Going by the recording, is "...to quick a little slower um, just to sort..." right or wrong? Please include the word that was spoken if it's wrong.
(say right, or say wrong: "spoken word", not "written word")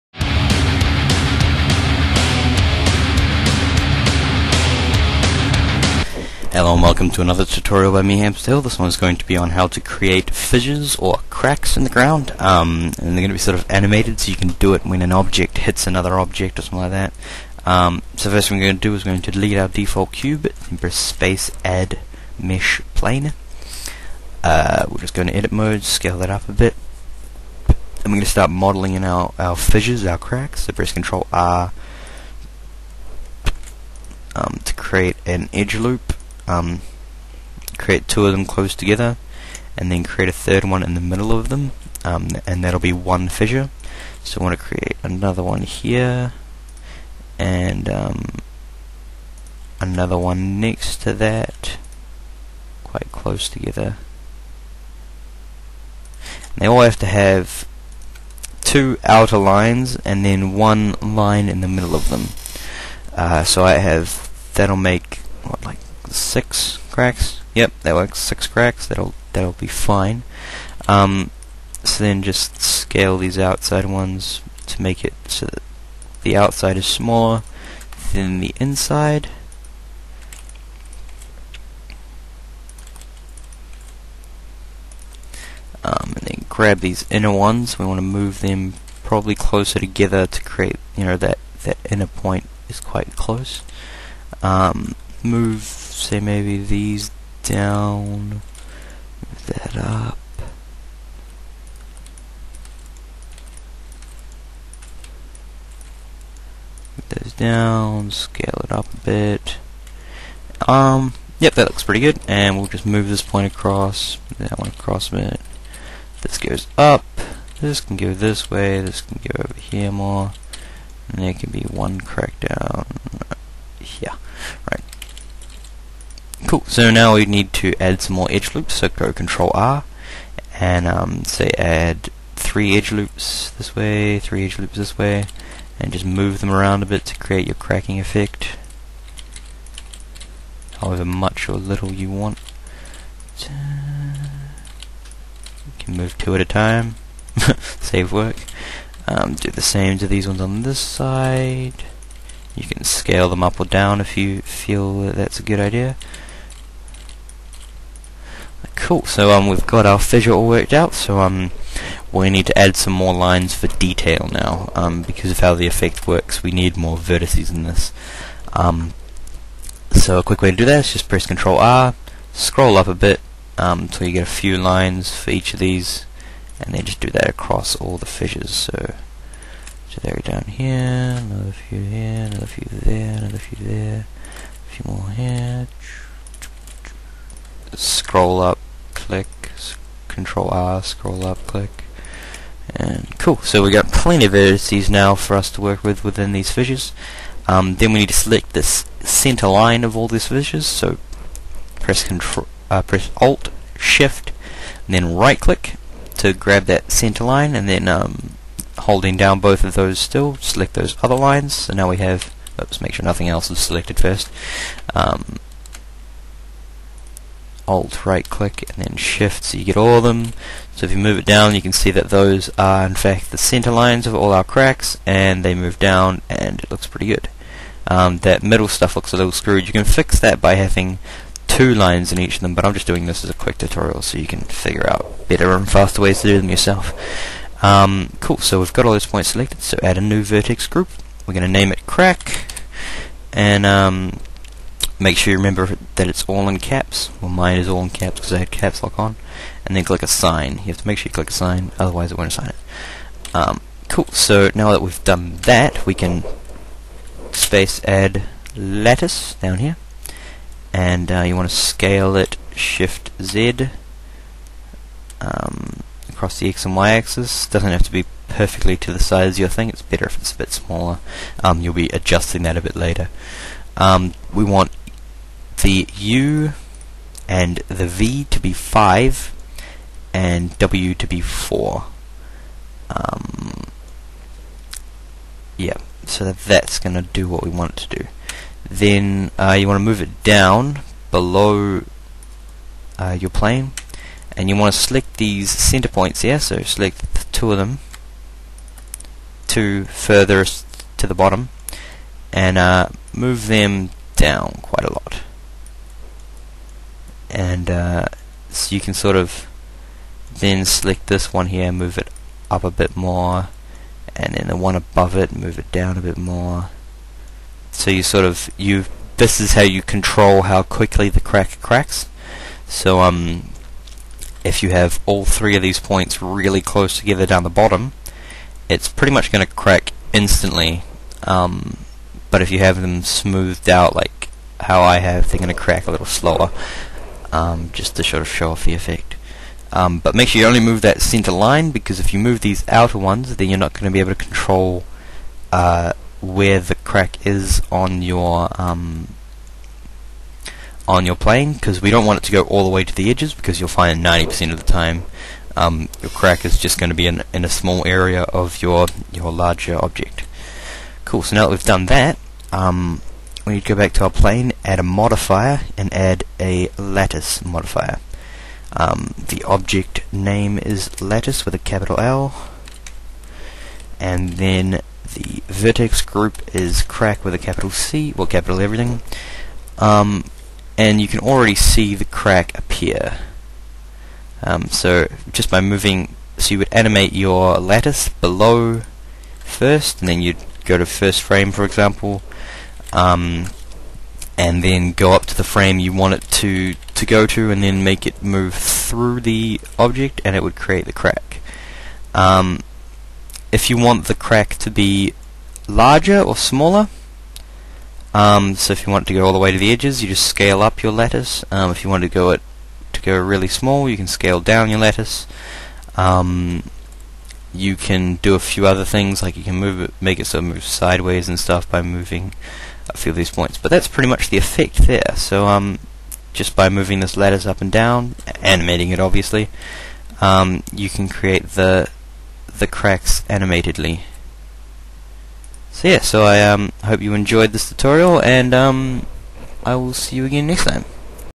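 wrong: "crack", not "quick".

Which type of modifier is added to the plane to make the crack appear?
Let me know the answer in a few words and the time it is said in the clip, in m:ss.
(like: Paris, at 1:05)
lattice modifier, at 6:06.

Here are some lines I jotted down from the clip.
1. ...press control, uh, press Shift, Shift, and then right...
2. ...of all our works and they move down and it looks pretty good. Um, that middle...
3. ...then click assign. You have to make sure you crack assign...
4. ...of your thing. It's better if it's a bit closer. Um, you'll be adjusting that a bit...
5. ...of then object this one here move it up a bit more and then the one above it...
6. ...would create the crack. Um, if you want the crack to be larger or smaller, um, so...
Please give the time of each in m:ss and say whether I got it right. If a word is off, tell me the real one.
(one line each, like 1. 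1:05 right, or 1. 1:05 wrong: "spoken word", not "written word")
1. 3:21 wrong: "Alt", not "Shift"
2. 3:44 wrong: "cracks", not "works"
3. 4:09 wrong: "click", not "crack"
4. 4:29 wrong: "smaller", not "closer"
5. 5:09 wrong: "select", not "object"
6. 6:40 right.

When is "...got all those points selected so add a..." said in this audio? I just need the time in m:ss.
3:58.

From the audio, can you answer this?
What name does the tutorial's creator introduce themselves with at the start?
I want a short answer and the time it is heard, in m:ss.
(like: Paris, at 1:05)
Hamsterhill, at 0:08.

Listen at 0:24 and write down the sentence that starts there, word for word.
Uh, we're just going to edit mode, scale that up a bit.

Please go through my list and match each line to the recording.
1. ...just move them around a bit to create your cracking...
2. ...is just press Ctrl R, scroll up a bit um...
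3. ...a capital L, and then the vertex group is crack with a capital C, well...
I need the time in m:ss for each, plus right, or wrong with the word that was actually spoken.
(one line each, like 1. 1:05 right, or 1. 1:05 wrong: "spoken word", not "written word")
1. 2:15 right
2. 2:50 right
3. 6:11 right.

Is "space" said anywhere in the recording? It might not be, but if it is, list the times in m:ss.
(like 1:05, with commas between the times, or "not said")
0:20, 4:17.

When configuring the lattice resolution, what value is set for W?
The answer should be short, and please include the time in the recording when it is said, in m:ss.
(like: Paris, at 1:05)
4, at 4:41.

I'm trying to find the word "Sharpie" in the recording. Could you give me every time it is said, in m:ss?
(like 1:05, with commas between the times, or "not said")
not said.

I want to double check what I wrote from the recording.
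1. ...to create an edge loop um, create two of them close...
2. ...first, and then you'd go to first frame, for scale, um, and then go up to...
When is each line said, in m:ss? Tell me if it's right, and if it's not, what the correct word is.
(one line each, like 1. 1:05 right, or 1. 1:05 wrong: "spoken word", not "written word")
1. 0:34 right
2. 6:29 wrong: "example", not "scale".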